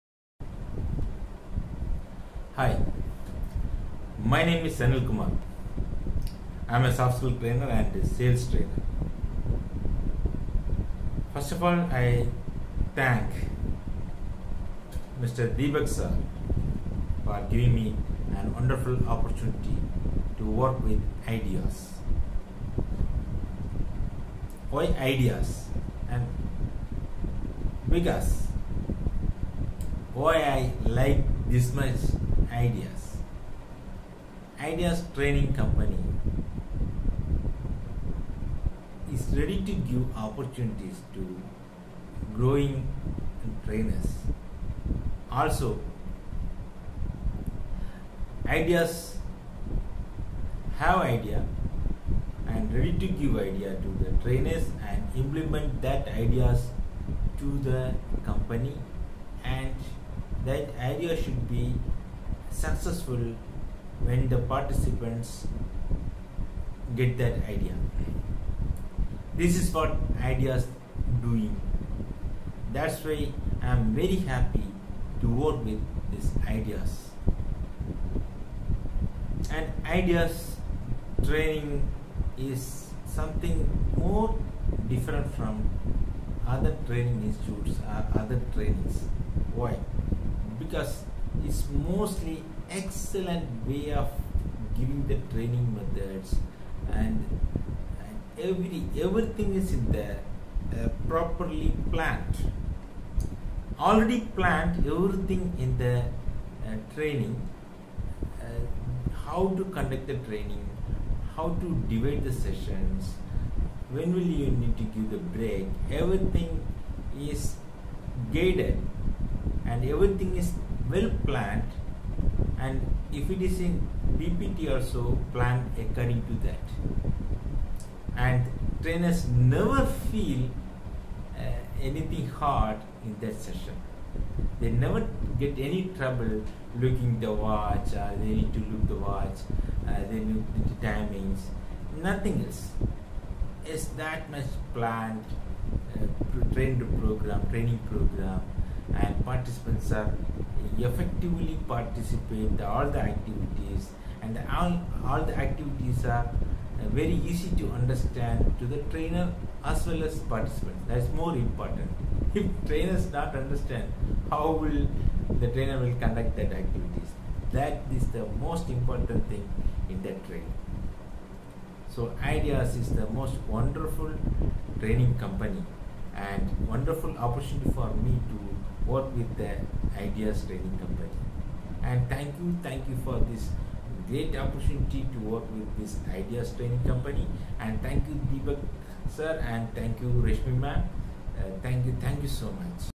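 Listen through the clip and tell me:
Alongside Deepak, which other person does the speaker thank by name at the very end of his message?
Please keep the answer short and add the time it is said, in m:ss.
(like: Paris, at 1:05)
Reshmi, at 3:10.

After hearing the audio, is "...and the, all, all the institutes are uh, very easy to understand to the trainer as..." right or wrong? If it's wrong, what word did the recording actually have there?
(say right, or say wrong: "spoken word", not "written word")
wrong: "activities", not "institutes".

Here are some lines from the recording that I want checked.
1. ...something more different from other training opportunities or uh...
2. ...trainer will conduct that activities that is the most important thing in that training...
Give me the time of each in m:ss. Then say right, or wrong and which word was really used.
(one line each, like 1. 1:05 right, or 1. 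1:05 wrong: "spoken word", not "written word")
1. 1:23 wrong: "institutes", not "opportunities"
2. 2:45 right.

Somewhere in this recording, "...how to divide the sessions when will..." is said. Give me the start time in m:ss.
1:51.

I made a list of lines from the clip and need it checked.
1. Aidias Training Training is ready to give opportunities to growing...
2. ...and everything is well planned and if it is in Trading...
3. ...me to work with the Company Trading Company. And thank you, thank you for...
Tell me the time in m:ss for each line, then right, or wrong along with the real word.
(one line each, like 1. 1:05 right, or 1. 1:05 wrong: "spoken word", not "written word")
1. 0:34 wrong: "Company", not "Training"
2. 1:59 wrong: "BPT", not "Trading"
3. 2:57 wrong: "Aidias", not "Company".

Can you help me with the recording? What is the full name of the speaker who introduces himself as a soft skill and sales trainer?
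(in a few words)
Sanil Kumar.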